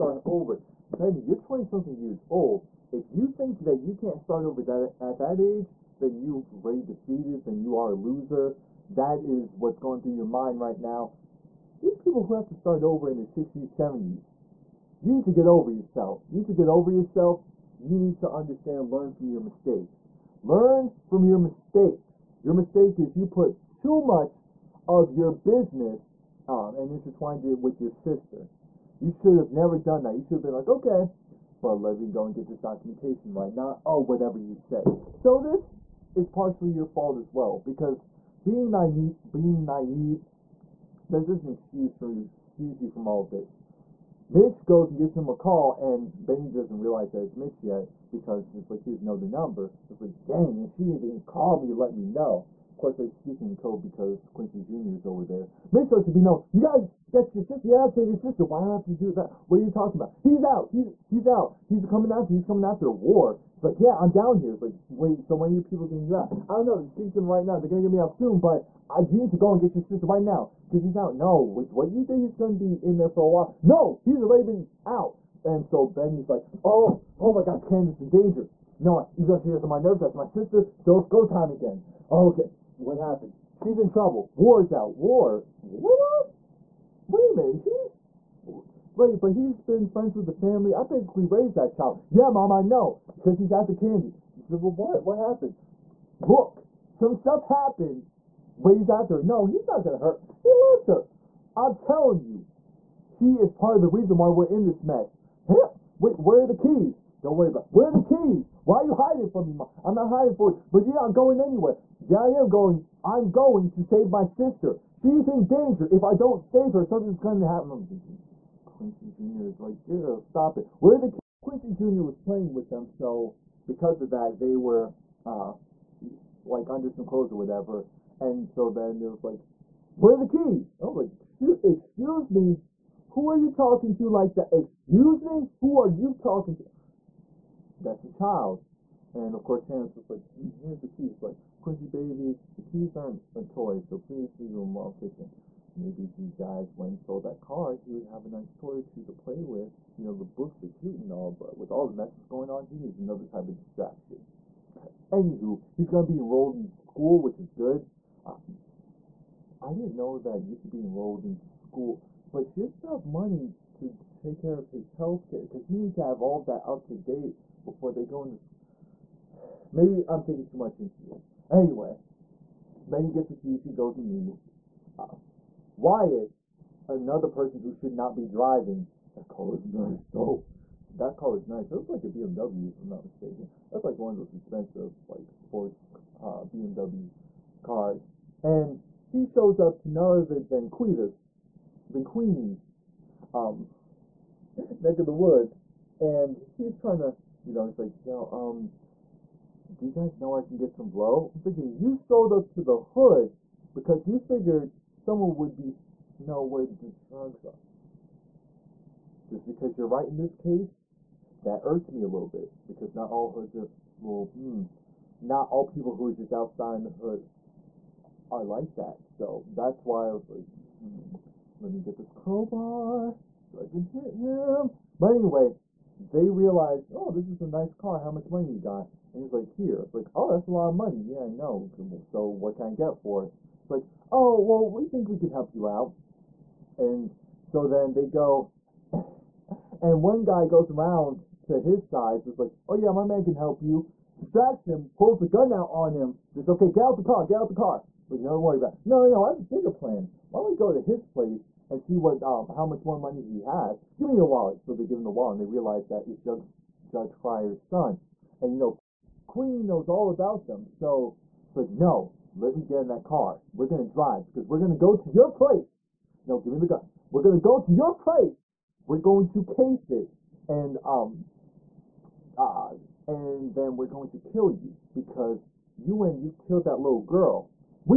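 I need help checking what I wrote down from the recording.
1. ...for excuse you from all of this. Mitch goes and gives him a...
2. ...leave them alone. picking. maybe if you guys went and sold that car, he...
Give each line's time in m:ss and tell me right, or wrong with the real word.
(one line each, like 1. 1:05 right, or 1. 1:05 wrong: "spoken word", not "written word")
1. 0:41 right
2. 2:24 right.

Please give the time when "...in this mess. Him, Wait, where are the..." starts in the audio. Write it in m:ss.
1:44.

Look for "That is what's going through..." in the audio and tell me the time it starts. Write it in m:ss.
0:08.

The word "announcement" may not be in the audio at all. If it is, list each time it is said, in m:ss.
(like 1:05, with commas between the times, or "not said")
not said.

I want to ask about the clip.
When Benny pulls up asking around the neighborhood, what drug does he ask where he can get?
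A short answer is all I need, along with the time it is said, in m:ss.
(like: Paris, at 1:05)
Blow, at 3:20.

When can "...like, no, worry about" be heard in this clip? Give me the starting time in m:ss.
4:08.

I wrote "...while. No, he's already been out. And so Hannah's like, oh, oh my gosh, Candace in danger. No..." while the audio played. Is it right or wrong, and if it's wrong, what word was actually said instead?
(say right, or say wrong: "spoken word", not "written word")
wrong: "Benny", not "Hannah".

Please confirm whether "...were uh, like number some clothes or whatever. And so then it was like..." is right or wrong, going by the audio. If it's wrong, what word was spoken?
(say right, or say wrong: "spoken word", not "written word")
wrong: "under", not "number".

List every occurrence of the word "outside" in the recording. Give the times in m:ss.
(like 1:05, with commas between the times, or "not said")
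3:36.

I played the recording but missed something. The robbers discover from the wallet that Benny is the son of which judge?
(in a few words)
Judge Cryer.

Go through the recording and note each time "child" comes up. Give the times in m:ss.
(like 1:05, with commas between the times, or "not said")
1:31, 2:18.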